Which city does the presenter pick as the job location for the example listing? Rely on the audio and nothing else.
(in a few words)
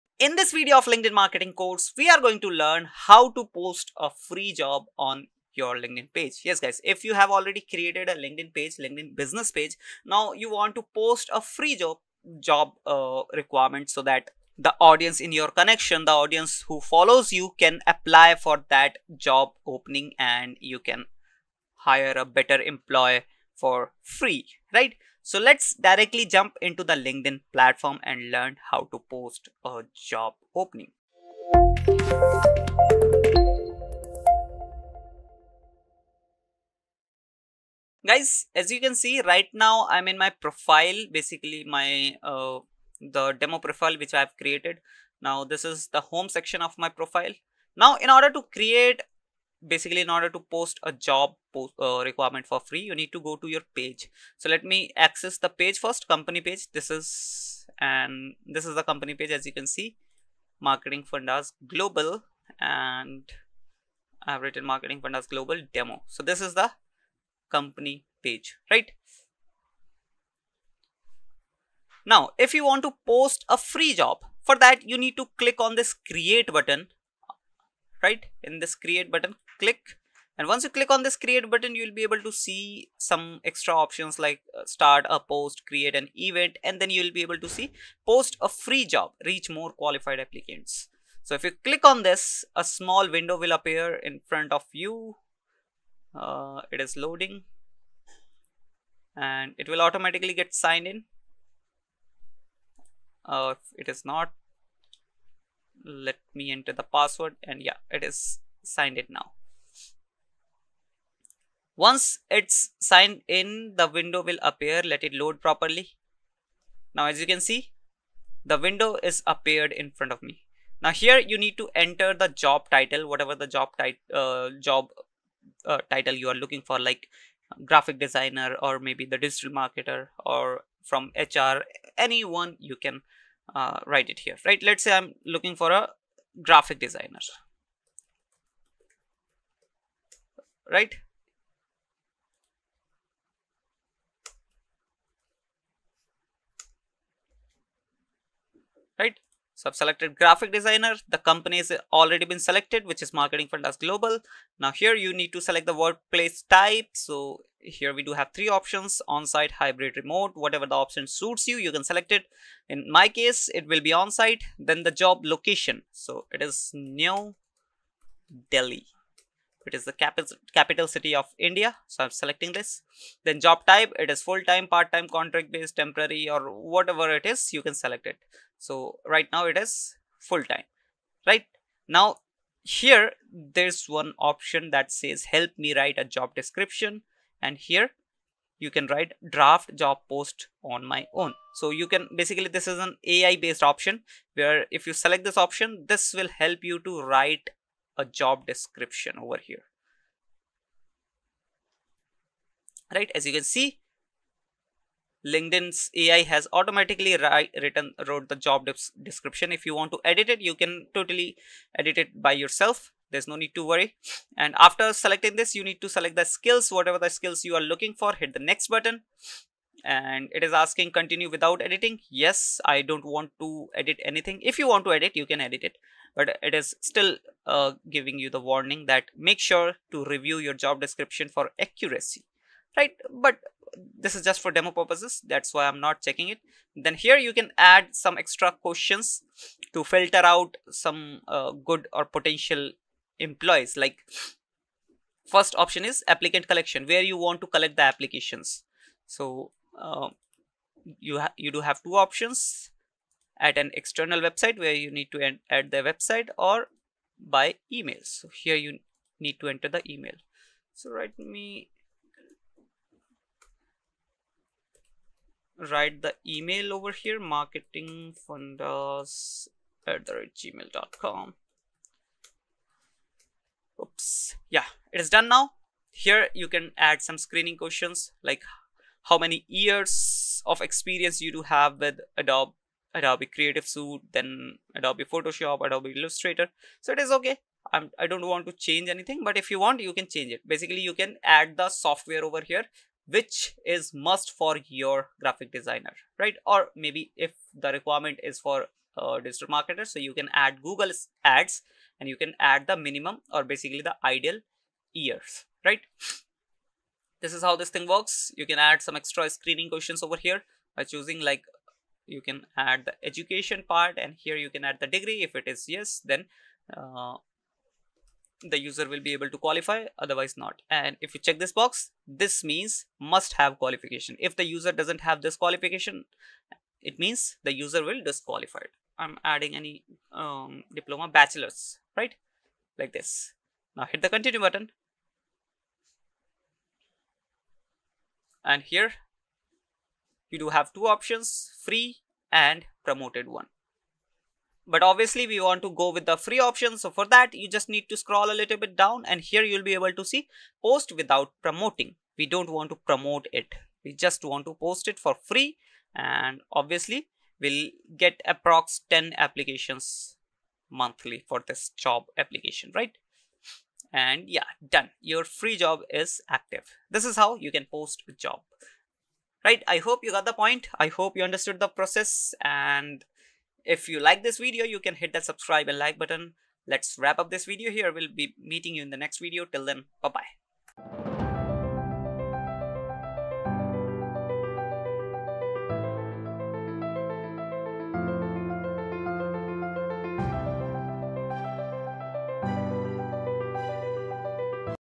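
New Delhi.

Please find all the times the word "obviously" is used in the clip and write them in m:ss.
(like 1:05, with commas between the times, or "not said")
5:44, 5:56.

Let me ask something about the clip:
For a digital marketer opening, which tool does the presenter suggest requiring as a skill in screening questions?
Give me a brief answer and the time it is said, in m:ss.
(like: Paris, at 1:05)
Google Ads, at 5:00.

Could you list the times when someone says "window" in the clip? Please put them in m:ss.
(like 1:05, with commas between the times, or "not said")
1:33, 1:53, 1:58.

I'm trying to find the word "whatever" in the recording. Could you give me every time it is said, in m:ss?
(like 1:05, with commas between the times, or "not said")
2:03, 2:40, 2:56, 3:36.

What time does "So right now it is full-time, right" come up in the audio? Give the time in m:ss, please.
2:58.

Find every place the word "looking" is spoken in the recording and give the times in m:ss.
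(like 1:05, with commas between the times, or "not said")
2:06, 2:15, 3:37.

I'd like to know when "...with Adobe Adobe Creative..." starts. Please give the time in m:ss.
4:41.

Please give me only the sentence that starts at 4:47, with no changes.
I'm, I do not want to change anything, but if you want, you can change it.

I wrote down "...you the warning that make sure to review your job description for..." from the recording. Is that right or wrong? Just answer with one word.
right.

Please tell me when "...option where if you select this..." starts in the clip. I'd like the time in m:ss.
3:13.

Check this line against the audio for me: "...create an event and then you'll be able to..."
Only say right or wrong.
right.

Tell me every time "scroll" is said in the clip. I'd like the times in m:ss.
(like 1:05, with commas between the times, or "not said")
5:47.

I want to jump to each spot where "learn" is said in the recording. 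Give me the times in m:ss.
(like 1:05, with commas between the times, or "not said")
0:02, 0:28.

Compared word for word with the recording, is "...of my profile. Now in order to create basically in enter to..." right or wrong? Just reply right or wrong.
wrong.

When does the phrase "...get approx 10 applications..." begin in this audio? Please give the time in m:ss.
5:57.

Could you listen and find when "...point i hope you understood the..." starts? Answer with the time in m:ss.
6:10.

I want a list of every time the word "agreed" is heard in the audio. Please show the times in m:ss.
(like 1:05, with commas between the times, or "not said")
not said.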